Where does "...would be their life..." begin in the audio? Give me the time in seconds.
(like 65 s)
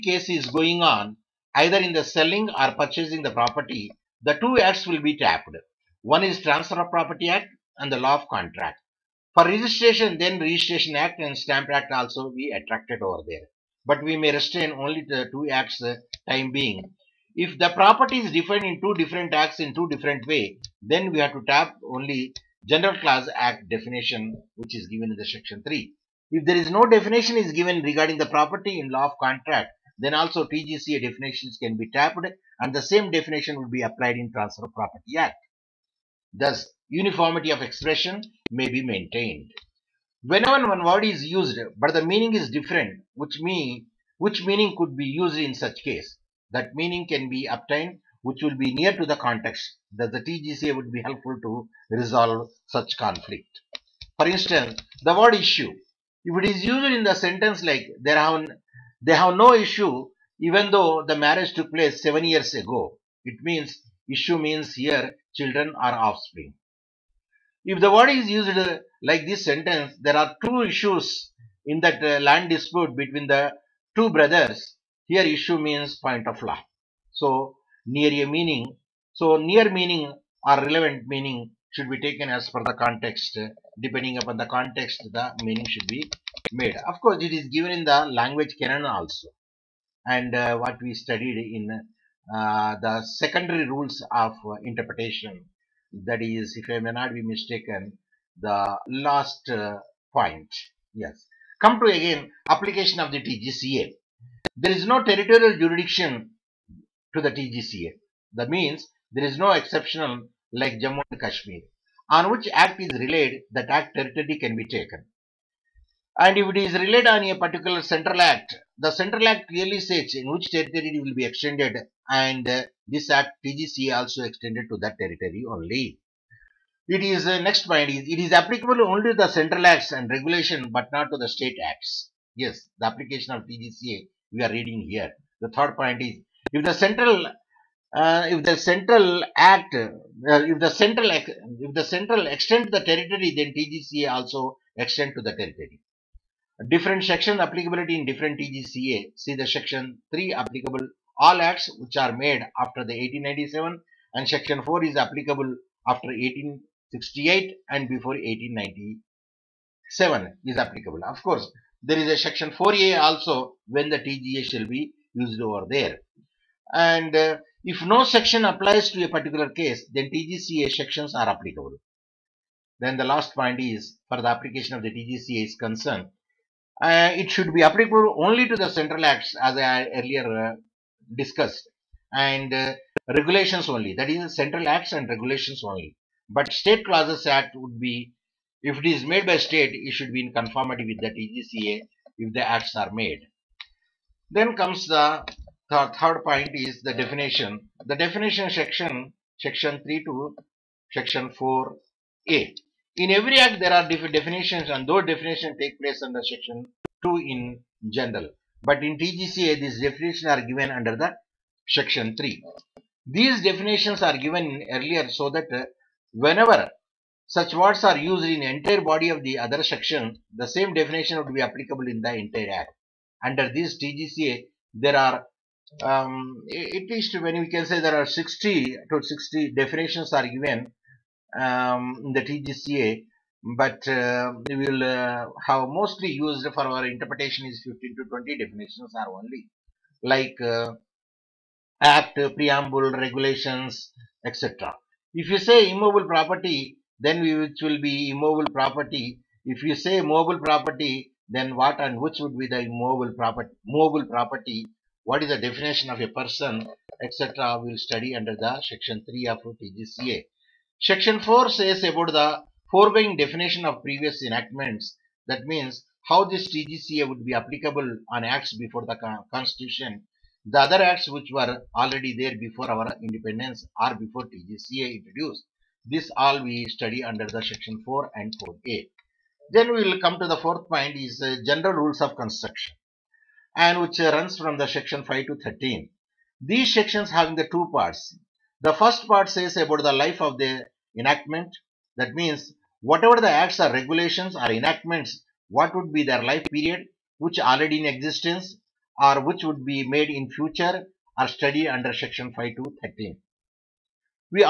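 295 s.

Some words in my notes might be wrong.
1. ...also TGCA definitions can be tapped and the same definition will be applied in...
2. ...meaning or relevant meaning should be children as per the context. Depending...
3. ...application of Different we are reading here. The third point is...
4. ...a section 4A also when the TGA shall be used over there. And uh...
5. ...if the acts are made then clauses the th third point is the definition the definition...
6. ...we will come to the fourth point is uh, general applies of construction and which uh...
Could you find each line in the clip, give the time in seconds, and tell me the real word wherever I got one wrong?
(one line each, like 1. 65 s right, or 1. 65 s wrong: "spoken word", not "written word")
1. 30 s right
2. 79 s wrong: "taken", not "children"
3. 132 s wrong: "TGCA", not "Different"
4. 162 s right
5. 192 s wrong: "comes", not "clauses"
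6. 279 s wrong: "rules", not "applies".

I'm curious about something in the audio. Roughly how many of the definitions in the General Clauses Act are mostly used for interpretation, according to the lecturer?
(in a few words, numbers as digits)
15 to 20.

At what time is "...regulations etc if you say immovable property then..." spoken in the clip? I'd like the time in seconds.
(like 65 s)
242 s.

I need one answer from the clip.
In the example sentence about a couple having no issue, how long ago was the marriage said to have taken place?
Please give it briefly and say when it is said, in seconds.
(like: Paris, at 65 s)
7 years, at 62 s.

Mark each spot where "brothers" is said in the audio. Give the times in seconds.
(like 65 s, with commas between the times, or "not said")
74 s.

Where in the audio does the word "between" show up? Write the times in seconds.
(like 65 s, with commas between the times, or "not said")
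72 s.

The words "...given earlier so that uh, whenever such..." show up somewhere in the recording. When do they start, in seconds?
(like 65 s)
214 s.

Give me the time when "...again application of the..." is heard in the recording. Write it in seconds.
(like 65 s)
101 s.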